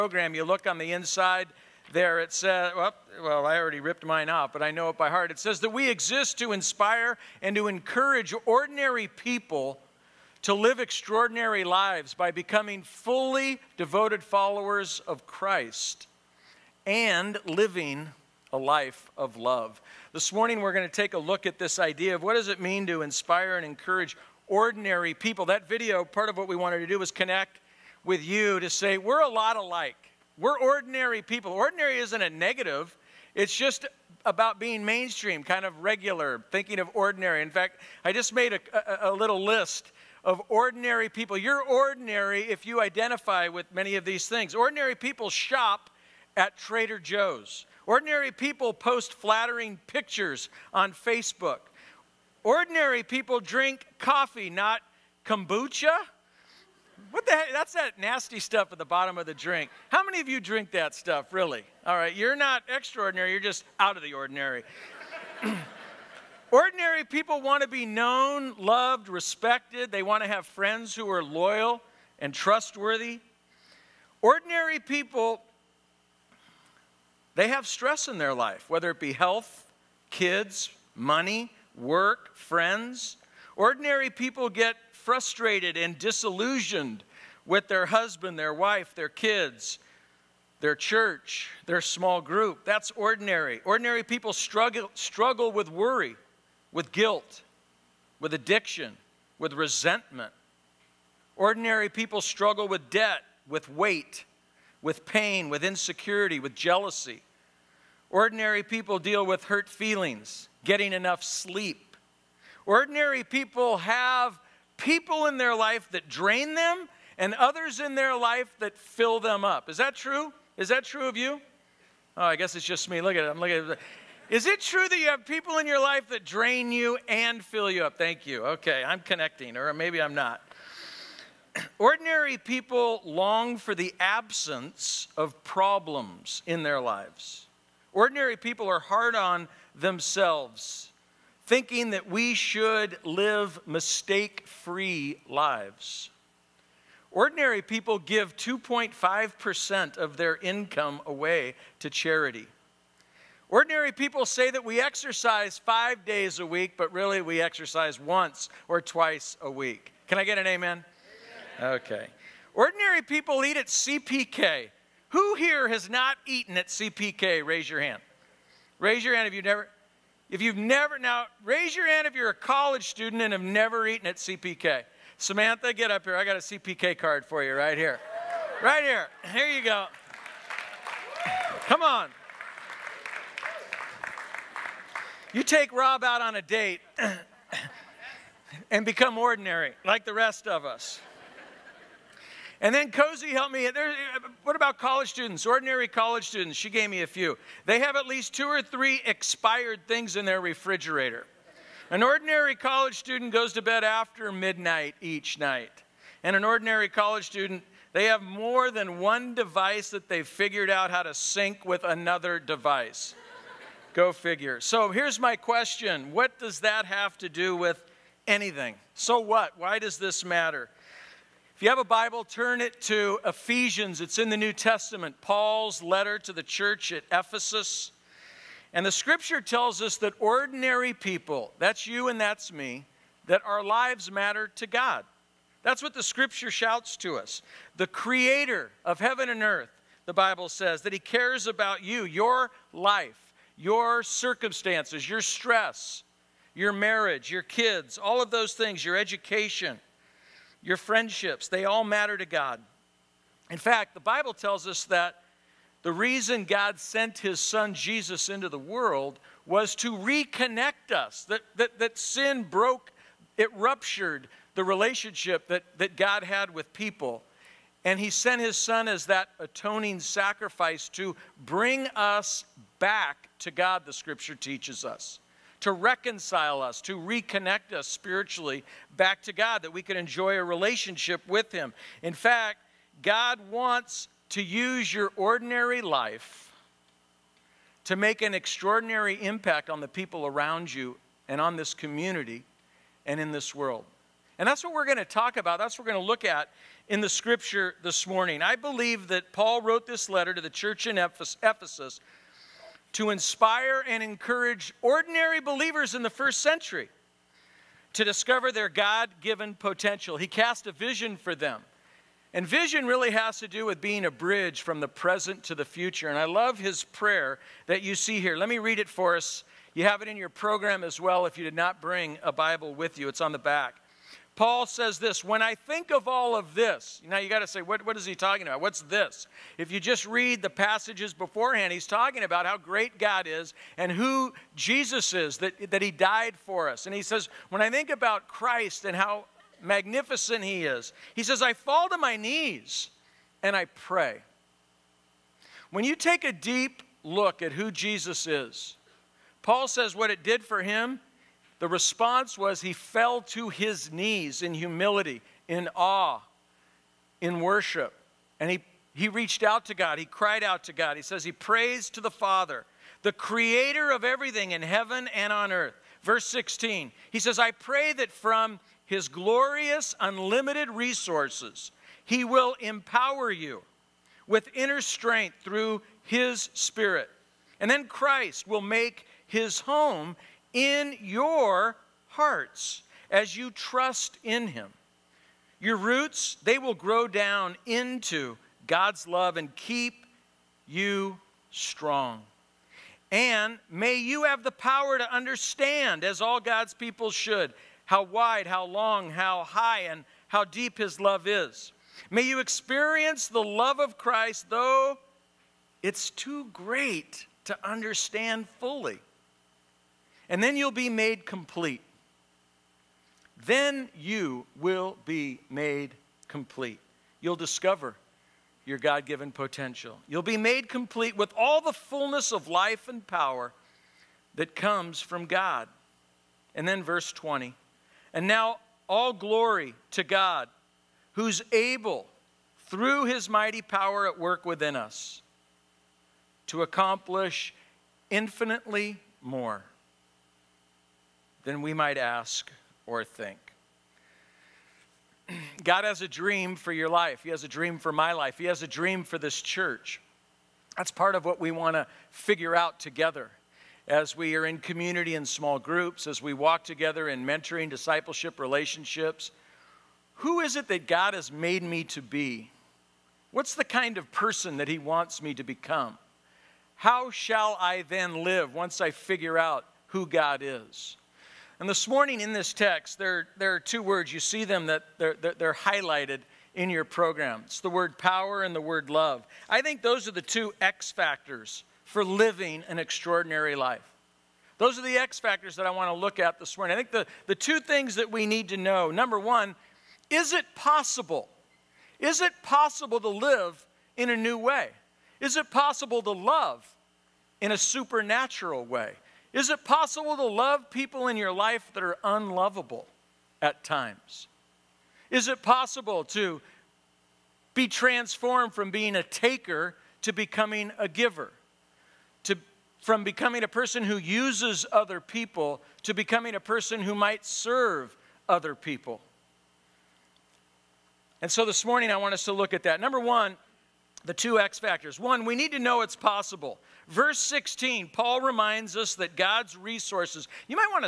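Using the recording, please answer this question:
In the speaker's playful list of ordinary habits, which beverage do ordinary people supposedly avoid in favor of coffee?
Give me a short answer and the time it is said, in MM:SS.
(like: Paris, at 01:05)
kombucha, at 00:55.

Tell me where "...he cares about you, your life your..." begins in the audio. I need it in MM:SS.
04:00.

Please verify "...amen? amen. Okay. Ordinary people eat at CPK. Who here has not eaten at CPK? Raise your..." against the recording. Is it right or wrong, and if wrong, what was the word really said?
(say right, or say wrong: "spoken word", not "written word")
right.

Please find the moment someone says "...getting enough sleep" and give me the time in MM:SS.
01:50.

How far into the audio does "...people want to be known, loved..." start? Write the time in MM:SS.
01:07.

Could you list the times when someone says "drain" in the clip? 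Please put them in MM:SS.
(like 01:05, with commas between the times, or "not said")
01:56, 02:06.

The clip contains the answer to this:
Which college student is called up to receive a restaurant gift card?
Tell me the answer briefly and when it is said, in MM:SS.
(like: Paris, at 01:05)
Samantha, at 02:55.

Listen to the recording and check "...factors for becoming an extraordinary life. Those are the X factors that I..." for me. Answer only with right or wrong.
wrong.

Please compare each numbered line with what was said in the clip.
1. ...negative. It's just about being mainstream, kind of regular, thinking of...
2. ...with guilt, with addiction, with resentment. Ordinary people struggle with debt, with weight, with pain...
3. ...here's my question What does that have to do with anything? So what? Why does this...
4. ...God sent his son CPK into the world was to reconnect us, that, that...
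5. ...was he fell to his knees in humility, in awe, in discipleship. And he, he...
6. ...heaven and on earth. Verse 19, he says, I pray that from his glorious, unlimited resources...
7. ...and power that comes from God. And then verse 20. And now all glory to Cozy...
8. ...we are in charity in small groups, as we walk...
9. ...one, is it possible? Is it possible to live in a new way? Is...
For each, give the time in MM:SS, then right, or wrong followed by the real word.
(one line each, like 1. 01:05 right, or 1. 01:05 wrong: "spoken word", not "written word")
1. 00:32 right
2. 01:36 right
3. 03:34 right
4. 04:16 wrong: "Jesus", not "CPK"
5. 05:52 wrong: "worship", not "discipleship"
6. 06:04 wrong: "16", not "19"
7. 07:02 wrong: "God", not "Cozy"
8. 07:34 wrong: "community", not "charity"
9. 08:09 right.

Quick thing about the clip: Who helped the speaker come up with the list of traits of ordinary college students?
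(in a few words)
Cozy.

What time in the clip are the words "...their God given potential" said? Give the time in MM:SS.
05:08.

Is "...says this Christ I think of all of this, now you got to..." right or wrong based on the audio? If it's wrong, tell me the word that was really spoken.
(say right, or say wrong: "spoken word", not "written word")
wrong: "When", not "Christ".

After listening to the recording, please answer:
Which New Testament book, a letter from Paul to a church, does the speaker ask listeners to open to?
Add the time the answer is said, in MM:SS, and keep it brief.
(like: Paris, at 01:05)
Ephesians, at 03:43.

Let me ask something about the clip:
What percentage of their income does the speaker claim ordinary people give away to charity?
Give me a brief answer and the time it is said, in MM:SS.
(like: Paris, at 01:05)
2.5%, at 02:28.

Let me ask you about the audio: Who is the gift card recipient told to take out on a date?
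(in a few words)
Rob.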